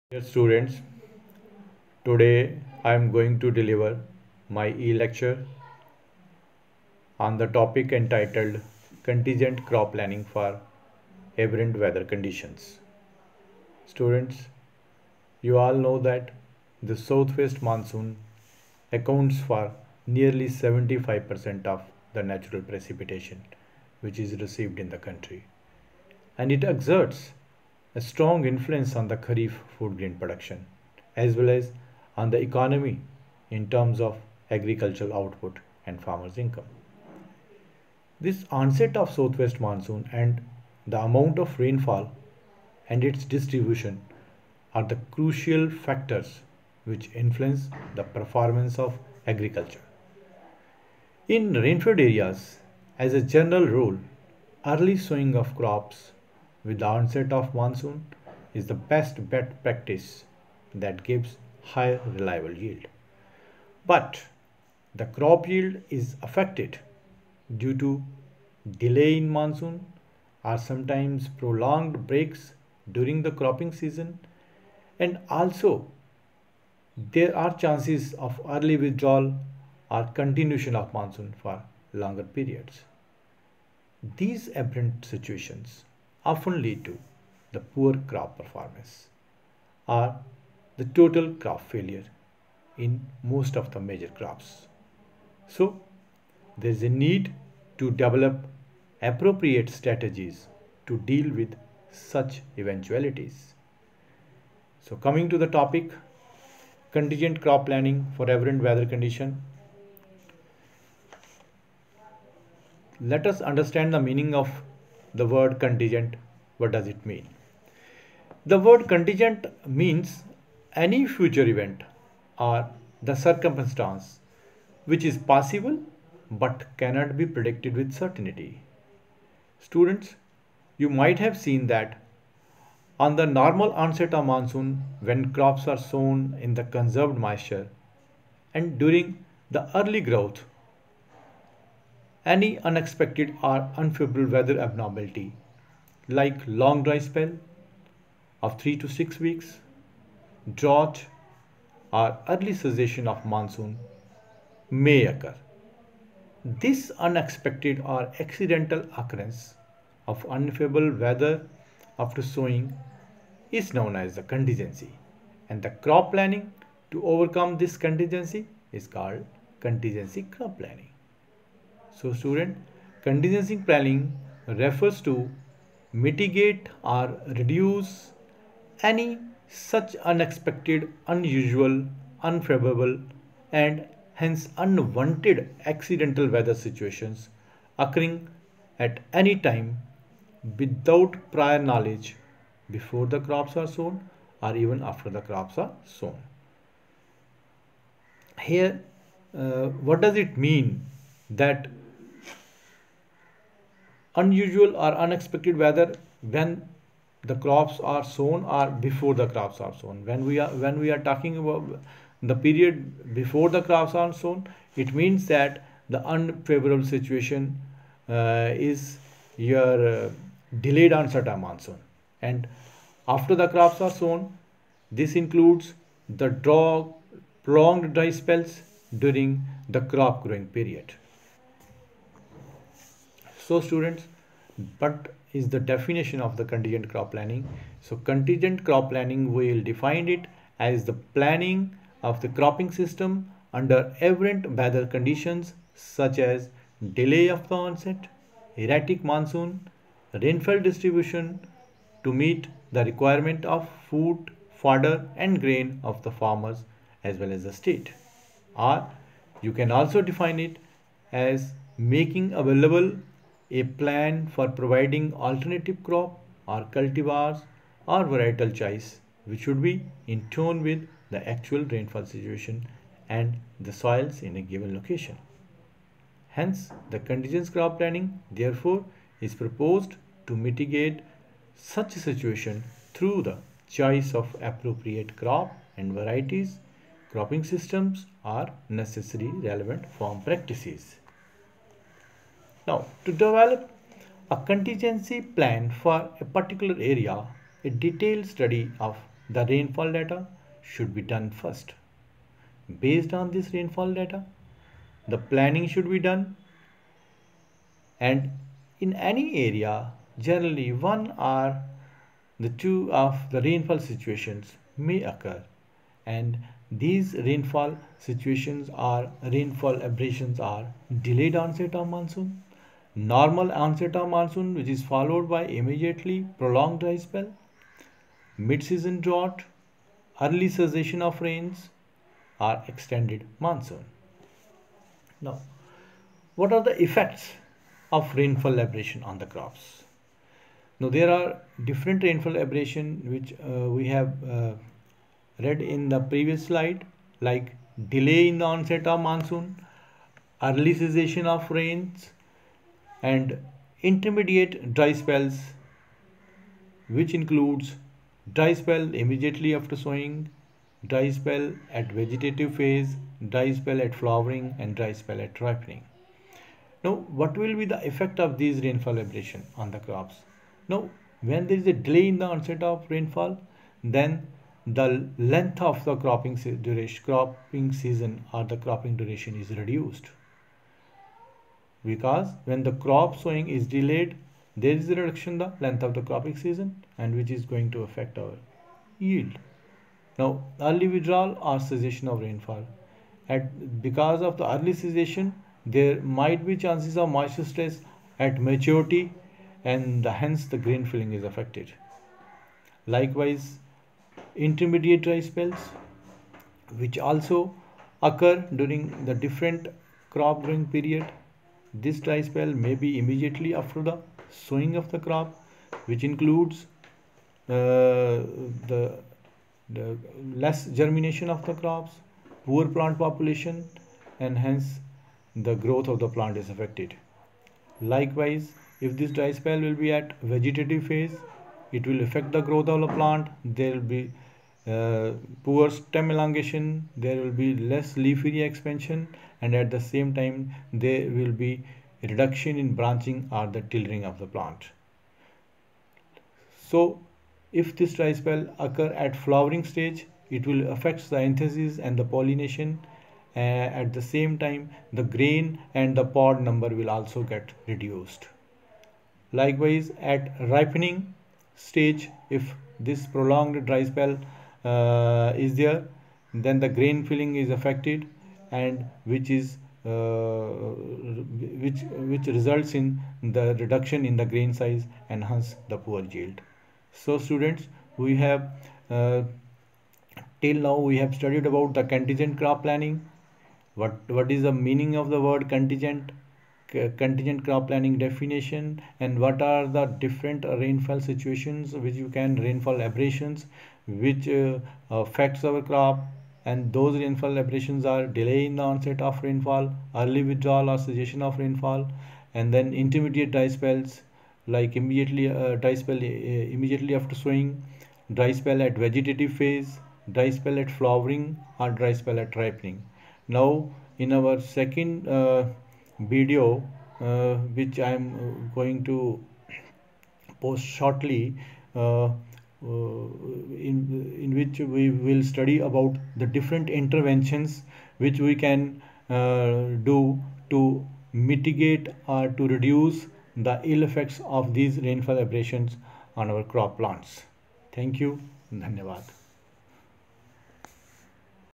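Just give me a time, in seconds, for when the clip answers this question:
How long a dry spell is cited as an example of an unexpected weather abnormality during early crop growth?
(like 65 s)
148 s.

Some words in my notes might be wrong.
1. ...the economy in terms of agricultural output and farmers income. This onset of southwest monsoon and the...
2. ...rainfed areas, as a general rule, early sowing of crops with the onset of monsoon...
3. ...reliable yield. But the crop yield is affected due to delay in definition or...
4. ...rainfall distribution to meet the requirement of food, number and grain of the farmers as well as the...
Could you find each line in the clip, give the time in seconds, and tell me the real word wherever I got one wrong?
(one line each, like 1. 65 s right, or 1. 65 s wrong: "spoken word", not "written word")
1. 32 s right
2. 51 s right
3. 62 s wrong: "monsoon", not "definition"
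4. 250 s wrong: "fodder", not "number".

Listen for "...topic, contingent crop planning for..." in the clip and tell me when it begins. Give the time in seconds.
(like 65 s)
105 s.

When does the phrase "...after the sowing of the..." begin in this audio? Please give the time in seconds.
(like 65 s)
413 s.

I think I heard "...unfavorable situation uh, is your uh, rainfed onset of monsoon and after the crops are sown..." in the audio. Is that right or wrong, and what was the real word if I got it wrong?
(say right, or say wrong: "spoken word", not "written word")
wrong: "delayed", not "rainfed".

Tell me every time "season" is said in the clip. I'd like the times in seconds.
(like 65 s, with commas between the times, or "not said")
73 s, 328 s, 377 s, 386 s.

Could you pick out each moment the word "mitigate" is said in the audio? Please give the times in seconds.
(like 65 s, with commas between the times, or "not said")
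175 s, 280 s, 531 s.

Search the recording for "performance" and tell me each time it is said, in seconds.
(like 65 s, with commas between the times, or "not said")
48 s, 88 s.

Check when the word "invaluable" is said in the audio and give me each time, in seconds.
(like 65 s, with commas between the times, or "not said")
not said.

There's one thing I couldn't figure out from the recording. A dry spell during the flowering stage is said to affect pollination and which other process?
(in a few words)
anthesis.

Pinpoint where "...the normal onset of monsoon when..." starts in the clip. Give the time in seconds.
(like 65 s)
133 s.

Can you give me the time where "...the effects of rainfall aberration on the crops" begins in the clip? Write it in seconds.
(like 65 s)
336 s.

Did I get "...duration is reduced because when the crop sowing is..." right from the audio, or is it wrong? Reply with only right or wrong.
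right.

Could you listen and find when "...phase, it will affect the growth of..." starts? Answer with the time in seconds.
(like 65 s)
430 s.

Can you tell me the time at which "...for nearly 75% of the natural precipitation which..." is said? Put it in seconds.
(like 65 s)
19 s.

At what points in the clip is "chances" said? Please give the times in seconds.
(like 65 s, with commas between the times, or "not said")
77 s, 396 s.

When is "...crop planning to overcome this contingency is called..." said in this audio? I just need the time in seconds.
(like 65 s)
165 s.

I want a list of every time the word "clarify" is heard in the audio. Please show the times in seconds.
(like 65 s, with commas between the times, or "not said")
not said.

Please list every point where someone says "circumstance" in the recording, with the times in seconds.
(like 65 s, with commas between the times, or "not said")
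123 s.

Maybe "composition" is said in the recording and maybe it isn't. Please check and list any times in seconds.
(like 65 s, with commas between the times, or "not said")
not said.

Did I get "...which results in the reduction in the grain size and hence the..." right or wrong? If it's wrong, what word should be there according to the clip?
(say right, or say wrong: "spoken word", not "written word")
right.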